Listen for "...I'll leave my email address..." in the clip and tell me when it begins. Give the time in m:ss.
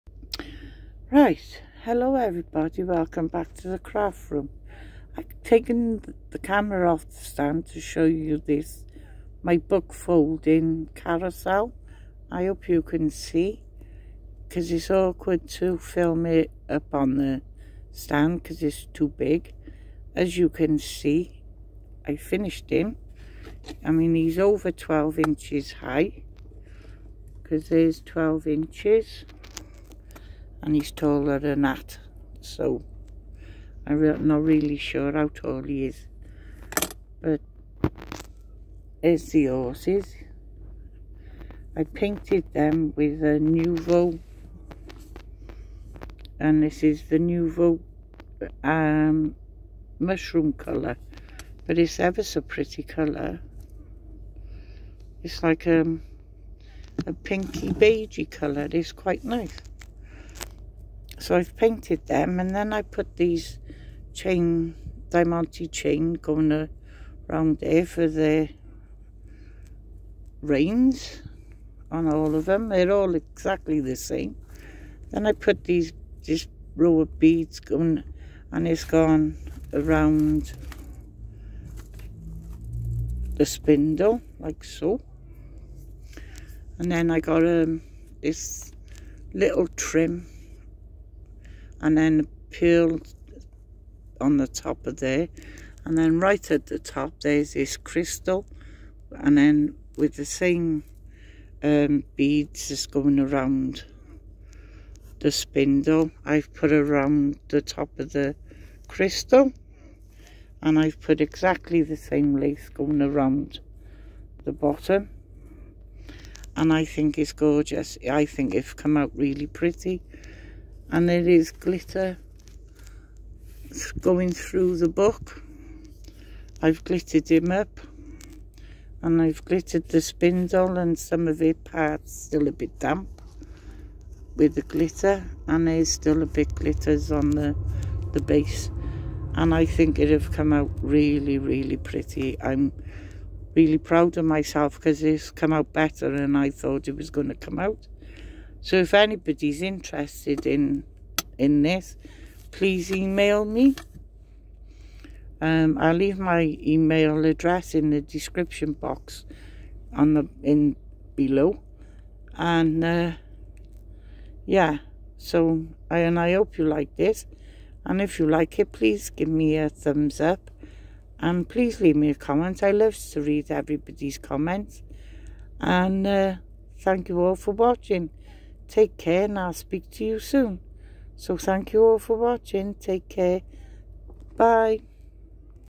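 2:35.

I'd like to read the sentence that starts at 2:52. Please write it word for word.
I love to read everybody's comments, and uh, thank you all for watching.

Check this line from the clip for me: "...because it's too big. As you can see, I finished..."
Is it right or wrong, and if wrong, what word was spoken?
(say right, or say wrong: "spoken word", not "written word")
right.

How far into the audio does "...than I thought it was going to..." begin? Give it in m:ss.
2:26.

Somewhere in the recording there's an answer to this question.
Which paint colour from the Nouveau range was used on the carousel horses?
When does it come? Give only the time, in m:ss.
0:49.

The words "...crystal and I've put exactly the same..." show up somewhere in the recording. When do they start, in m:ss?
1:48.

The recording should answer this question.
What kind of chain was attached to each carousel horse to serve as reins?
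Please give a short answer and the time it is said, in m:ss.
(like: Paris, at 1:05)
diamante chain, at 1:05.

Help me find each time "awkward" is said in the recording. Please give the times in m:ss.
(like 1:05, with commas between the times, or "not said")
0:14.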